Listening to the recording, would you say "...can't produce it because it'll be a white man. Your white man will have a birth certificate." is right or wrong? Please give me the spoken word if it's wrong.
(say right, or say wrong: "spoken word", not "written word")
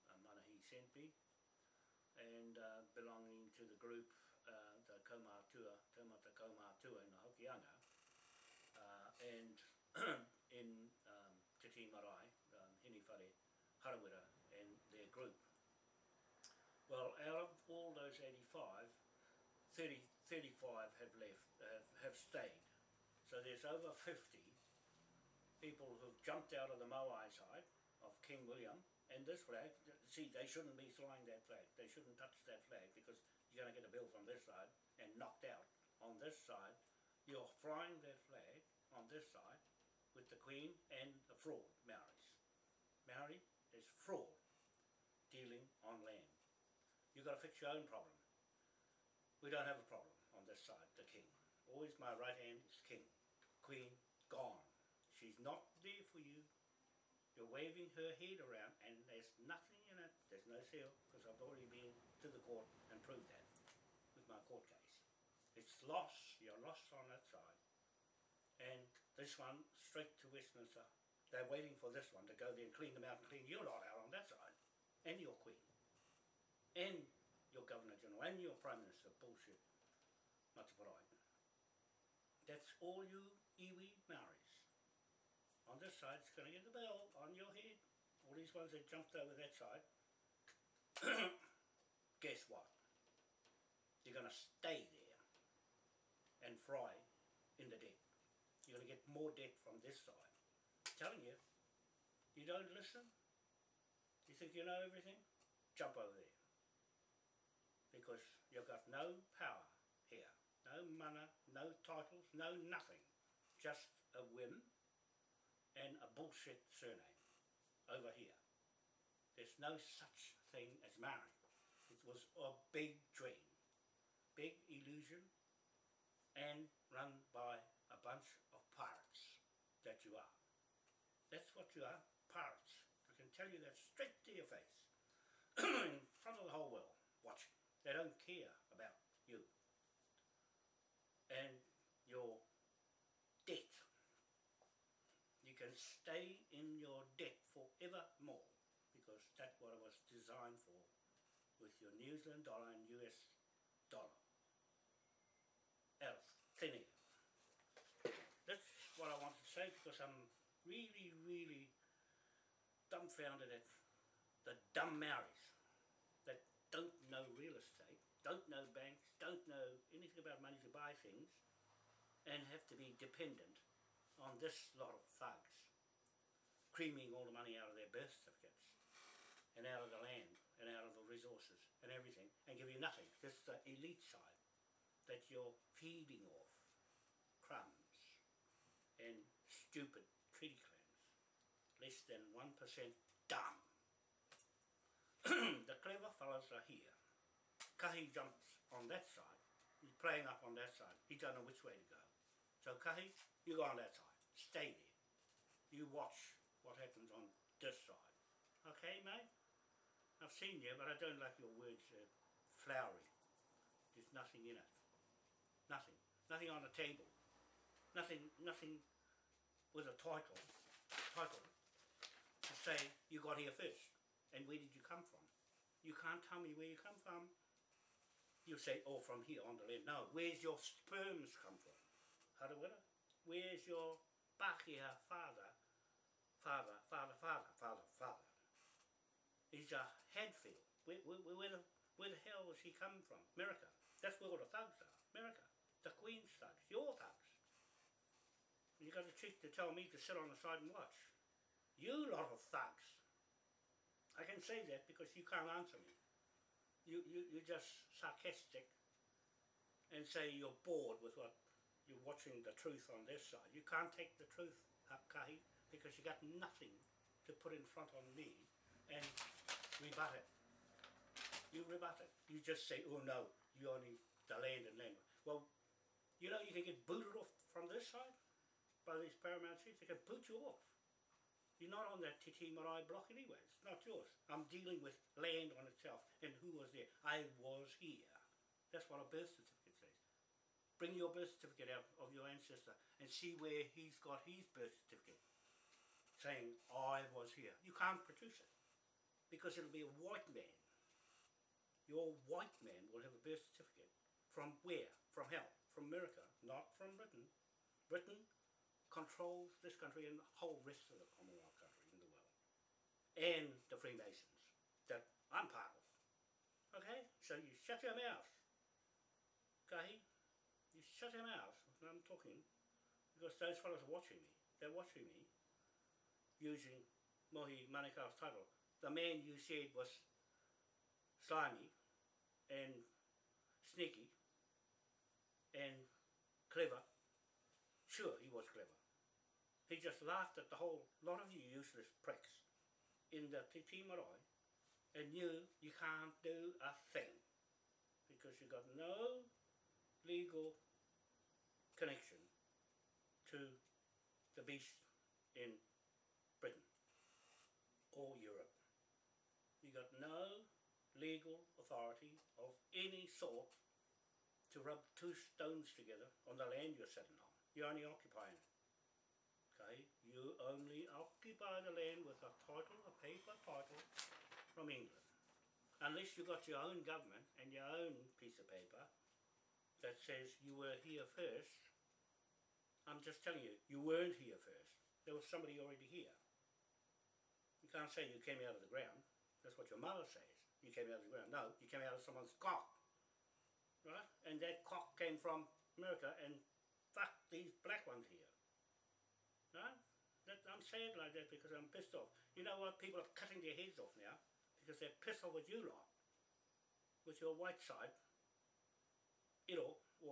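right.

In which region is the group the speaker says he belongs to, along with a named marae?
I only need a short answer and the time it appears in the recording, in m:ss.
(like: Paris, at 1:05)
Hokianga, at 0:07.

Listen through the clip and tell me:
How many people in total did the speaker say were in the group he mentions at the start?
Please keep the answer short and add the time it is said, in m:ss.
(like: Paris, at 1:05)
85, at 0:18.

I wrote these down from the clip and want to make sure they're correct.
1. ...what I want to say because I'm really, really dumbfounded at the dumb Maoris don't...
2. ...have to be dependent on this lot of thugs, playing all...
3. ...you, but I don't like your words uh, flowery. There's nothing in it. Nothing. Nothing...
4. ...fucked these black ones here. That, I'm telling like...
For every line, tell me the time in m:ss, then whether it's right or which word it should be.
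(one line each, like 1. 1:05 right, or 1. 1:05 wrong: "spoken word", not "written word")
1. 2:38 right
2. 2:52 wrong: "creaming", not "playing"
3. 3:30 right
4. 6:36 wrong: "saying", not "telling".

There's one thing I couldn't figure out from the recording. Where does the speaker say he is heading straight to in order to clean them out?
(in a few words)
Westminster.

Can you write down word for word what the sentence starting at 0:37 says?
You're flying that flag on this side with the Queen and the fraud, Maoris.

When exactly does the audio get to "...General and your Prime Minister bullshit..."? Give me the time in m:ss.
1:17.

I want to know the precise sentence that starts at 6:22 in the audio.
I'm just telling you, you weren't here first.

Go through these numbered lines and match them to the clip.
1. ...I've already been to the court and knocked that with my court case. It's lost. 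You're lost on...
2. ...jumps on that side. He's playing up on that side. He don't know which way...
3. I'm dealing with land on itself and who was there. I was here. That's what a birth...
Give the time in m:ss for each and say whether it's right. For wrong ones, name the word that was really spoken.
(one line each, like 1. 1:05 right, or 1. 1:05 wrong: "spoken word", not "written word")
1. 1:01 wrong: "proved", not "knocked"
2. 3:18 right
3. 4:44 right.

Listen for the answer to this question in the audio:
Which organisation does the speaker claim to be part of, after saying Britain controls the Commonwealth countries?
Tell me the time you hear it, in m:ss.
5:13.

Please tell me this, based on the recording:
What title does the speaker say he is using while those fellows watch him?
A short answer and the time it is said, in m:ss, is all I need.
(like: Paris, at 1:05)
Mohi Manikar, at 5:27.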